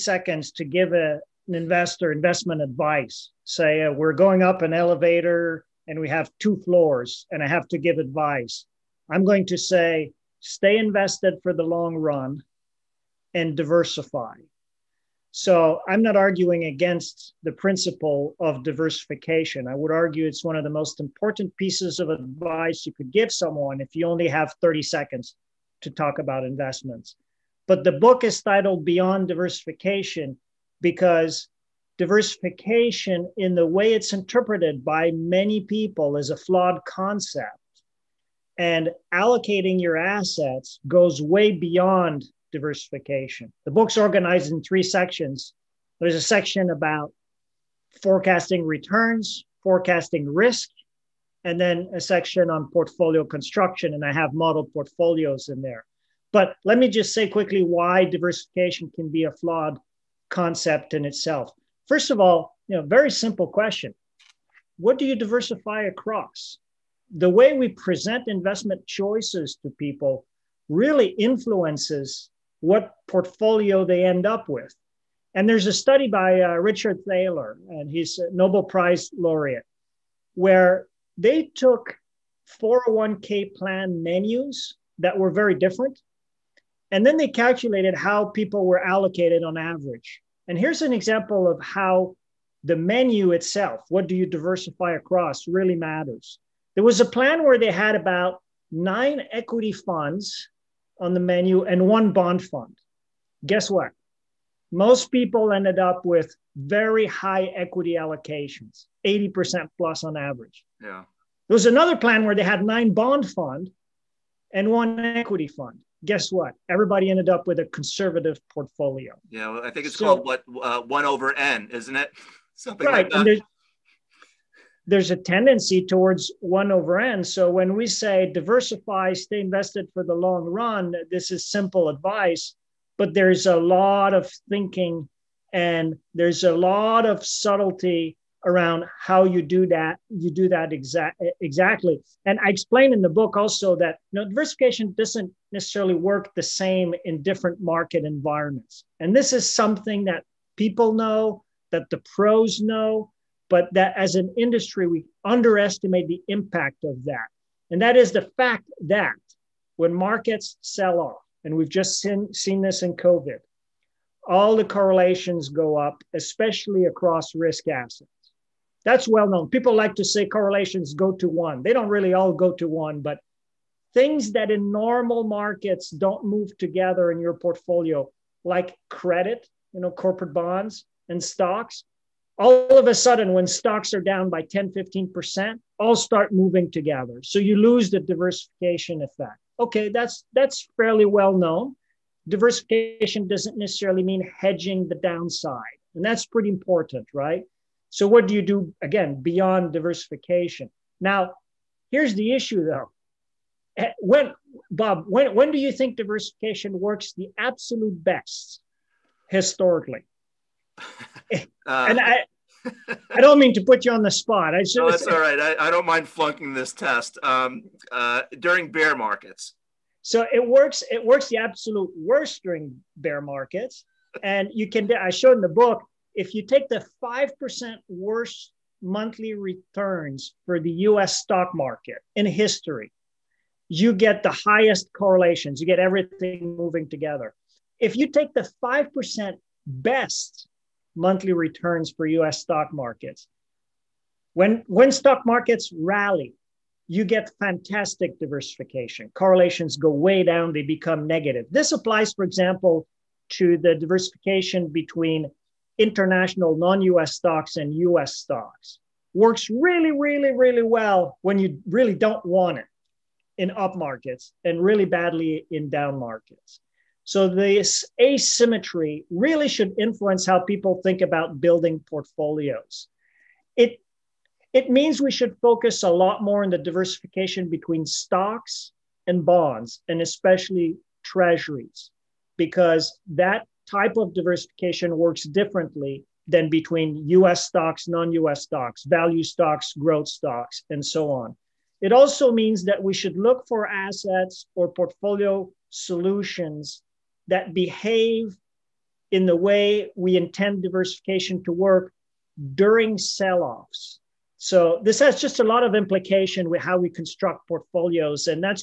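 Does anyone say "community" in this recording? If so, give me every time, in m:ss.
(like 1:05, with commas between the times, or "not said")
not said.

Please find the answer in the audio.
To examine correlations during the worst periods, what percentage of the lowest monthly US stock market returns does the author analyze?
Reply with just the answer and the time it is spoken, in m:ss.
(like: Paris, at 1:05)
5%, at 3:47.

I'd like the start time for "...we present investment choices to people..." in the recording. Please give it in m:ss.
1:07.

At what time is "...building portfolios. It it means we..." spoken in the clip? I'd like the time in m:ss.
4:31.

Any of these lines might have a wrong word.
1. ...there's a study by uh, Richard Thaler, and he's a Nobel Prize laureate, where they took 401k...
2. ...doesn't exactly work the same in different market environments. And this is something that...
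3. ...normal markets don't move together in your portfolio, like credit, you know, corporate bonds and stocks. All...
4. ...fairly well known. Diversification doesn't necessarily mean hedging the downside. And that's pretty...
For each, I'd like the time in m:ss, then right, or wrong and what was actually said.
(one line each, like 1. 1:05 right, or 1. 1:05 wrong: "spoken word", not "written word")
1. 1:15 right
2. 2:24 wrong: "necessarily", not "exactly"
3. 2:54 right
4. 3:10 right.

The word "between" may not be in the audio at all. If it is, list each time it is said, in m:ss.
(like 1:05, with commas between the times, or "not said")
4:14, 4:37, 4:46.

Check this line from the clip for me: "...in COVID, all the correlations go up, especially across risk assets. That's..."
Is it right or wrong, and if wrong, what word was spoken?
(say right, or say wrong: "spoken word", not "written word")
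right.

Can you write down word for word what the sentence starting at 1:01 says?
First of all, you know, very simple question.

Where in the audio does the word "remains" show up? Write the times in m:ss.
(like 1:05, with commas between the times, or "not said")
not said.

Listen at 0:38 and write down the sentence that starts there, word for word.
And allocating your assets goes way beyond diversification.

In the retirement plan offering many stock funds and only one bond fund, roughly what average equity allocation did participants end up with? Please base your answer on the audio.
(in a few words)
80% plus.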